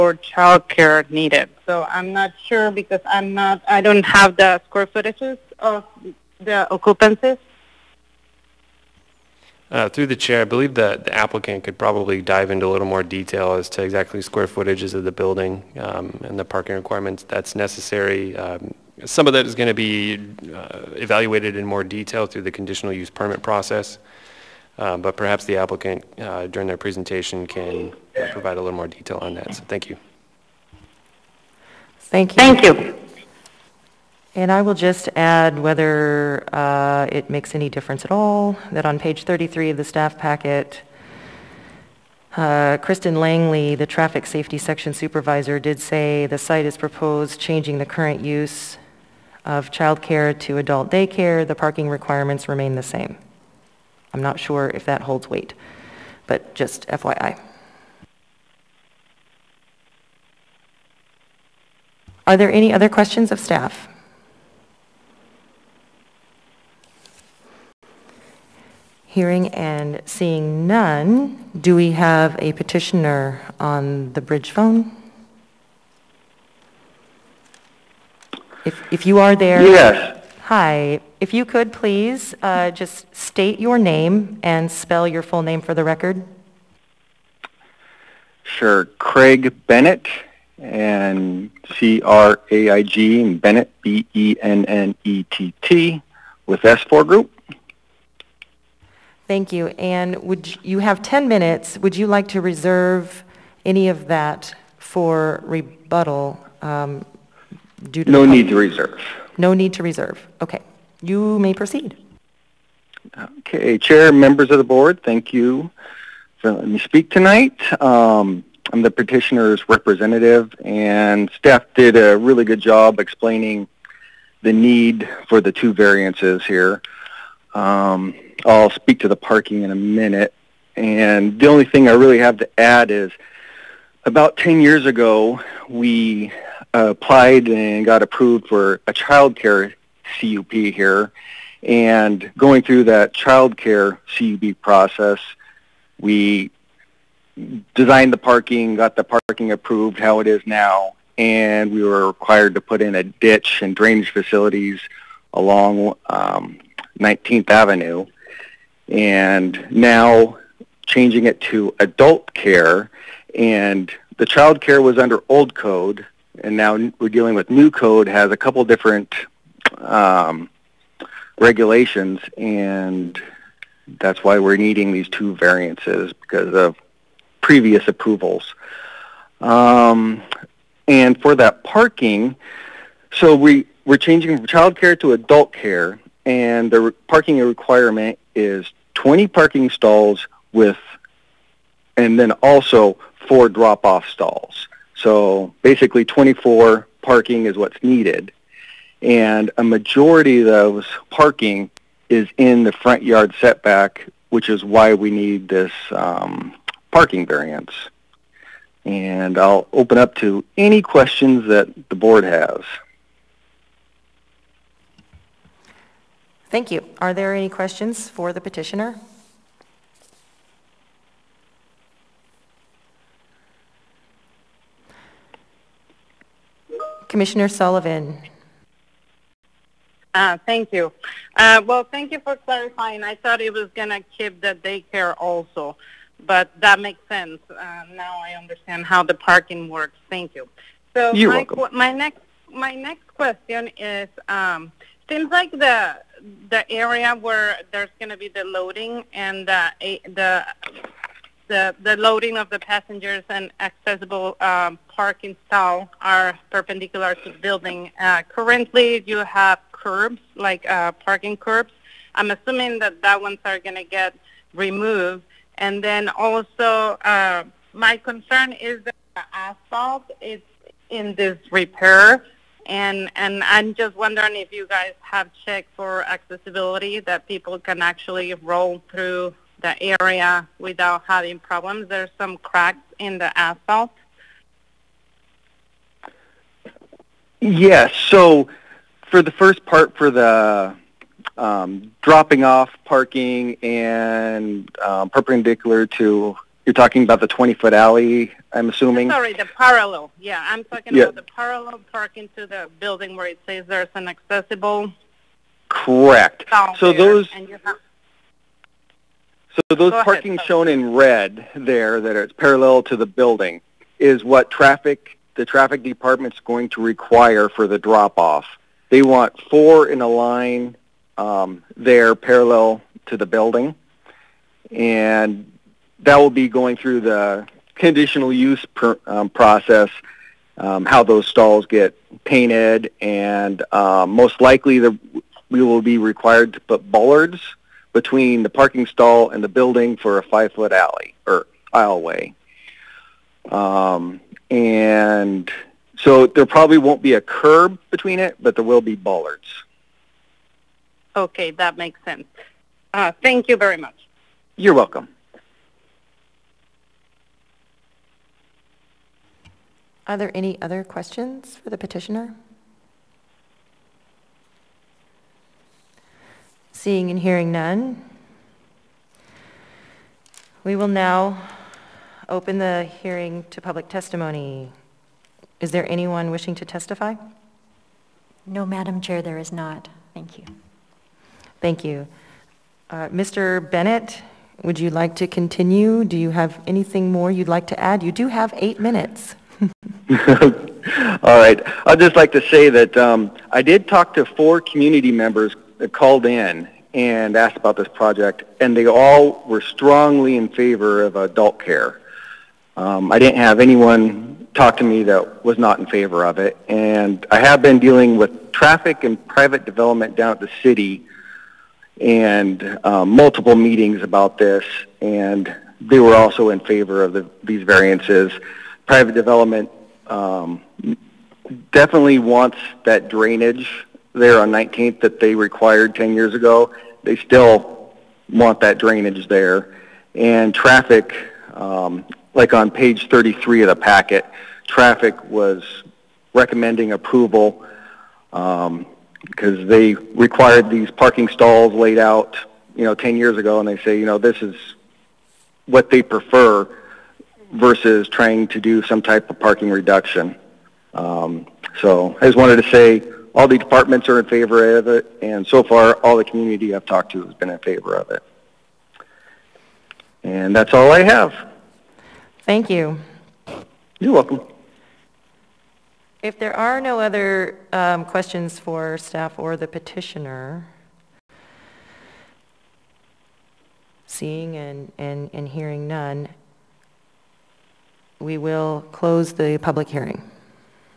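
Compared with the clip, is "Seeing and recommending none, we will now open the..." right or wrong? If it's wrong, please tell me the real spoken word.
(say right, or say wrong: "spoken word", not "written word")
wrong: "hearing", not "recommending".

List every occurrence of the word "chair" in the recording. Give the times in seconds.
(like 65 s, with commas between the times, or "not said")
10 s, 113 s, 378 s.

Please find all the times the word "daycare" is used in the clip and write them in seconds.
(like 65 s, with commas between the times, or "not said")
50 s, 234 s.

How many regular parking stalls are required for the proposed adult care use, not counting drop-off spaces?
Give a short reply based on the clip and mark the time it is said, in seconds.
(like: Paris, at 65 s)
20, at 189 s.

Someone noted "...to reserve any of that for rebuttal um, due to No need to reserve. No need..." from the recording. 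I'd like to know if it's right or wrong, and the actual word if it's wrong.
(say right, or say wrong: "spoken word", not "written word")
right.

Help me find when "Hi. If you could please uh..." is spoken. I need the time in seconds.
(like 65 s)
80 s.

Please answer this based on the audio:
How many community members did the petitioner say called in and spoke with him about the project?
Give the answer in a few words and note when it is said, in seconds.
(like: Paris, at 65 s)
4, at 394 s.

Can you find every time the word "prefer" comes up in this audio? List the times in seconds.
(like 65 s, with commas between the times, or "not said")
446 s.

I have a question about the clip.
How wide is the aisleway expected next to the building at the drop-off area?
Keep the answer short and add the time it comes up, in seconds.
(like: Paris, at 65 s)
5 feet, at 340 s.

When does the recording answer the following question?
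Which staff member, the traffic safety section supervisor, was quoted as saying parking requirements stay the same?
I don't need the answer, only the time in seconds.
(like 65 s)
42 s.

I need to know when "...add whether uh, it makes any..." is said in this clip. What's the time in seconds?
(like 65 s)
35 s.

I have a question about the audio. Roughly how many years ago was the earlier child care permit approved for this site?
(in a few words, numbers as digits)
10 years.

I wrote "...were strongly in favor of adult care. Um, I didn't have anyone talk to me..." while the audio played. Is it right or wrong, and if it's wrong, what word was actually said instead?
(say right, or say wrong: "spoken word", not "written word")
right.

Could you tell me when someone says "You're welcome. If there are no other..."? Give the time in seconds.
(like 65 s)
463 s.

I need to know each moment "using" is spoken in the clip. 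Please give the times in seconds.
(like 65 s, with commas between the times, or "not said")
not said.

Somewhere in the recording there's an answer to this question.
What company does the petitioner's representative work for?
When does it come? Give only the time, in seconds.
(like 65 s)
96 s.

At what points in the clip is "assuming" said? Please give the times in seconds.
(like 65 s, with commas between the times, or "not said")
262 s, 298 s.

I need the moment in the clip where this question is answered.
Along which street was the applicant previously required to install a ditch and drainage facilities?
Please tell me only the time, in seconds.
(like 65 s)
156 s.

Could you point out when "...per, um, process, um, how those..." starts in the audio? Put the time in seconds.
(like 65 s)
328 s.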